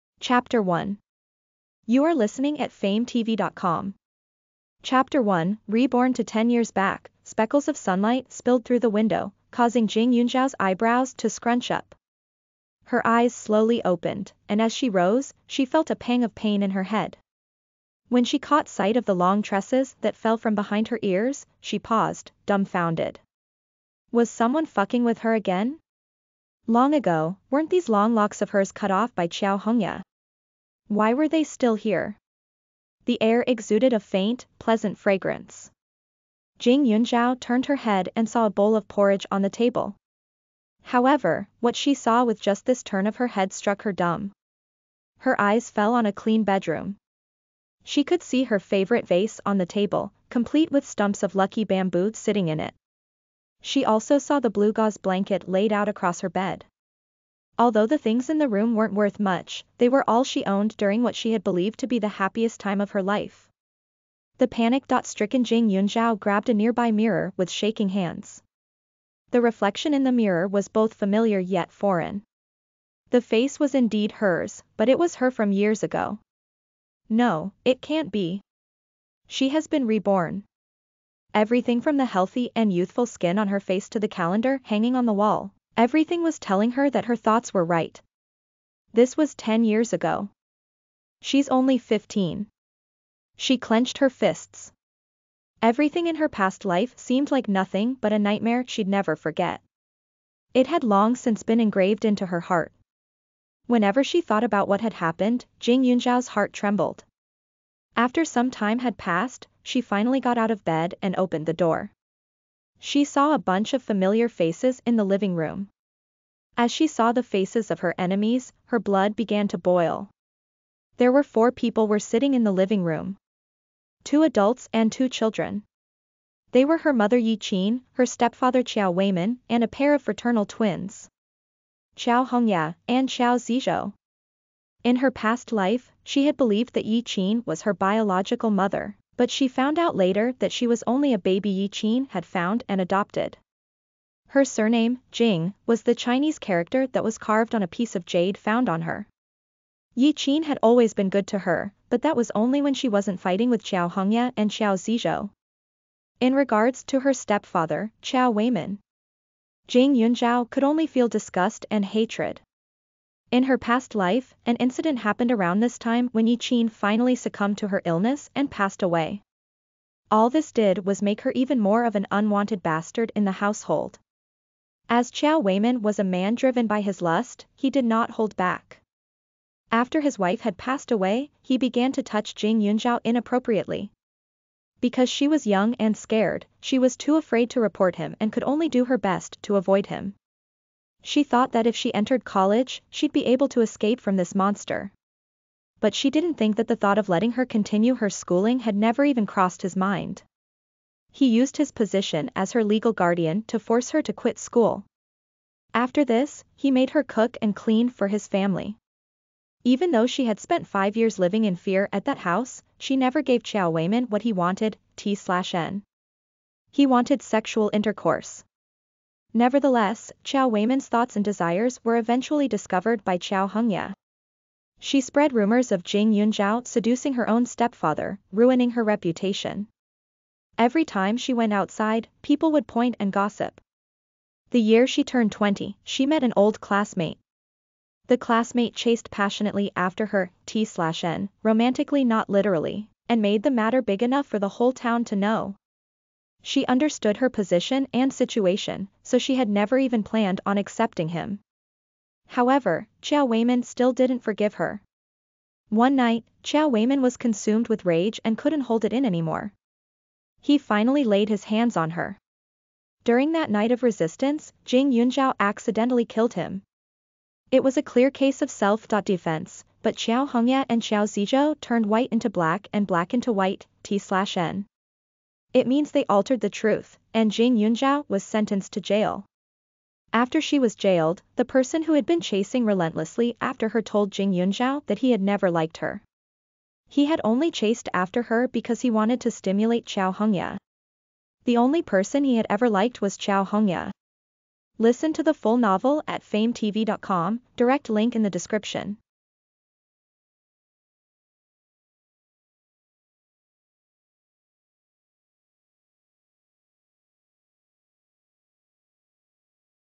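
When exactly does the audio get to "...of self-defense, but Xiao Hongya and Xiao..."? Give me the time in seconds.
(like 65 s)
268 s.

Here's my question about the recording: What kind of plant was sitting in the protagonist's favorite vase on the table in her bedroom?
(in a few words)
lucky bamboo.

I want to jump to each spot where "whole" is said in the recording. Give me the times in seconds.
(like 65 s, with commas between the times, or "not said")
244 s.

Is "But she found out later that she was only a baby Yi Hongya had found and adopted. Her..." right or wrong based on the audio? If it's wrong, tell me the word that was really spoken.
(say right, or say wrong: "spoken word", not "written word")
wrong: "Qin", not "Hongya".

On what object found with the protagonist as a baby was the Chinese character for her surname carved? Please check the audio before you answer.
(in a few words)
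a piece of jade.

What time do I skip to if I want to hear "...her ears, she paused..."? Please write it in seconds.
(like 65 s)
20 s.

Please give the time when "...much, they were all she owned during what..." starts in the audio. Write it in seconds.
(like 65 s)
59 s.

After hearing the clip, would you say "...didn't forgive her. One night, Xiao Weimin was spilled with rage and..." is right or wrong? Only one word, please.
wrong.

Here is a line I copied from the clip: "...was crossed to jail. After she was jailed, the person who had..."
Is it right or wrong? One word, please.
wrong.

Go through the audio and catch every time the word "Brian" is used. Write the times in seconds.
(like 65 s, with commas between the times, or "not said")
not said.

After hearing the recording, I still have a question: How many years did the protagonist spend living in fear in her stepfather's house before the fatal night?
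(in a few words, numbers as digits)
5.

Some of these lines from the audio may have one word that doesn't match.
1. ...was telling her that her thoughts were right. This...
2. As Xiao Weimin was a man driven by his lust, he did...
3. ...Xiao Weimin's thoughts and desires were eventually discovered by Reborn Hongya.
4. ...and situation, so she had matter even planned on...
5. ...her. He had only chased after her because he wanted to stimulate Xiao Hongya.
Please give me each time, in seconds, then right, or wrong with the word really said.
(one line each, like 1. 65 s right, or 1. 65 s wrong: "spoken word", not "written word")
1. 86 s right
2. 174 s right
3. 220 s wrong: "Xiao", not "Reborn"
4. 247 s wrong: "never", not "matter"
5. 285 s right.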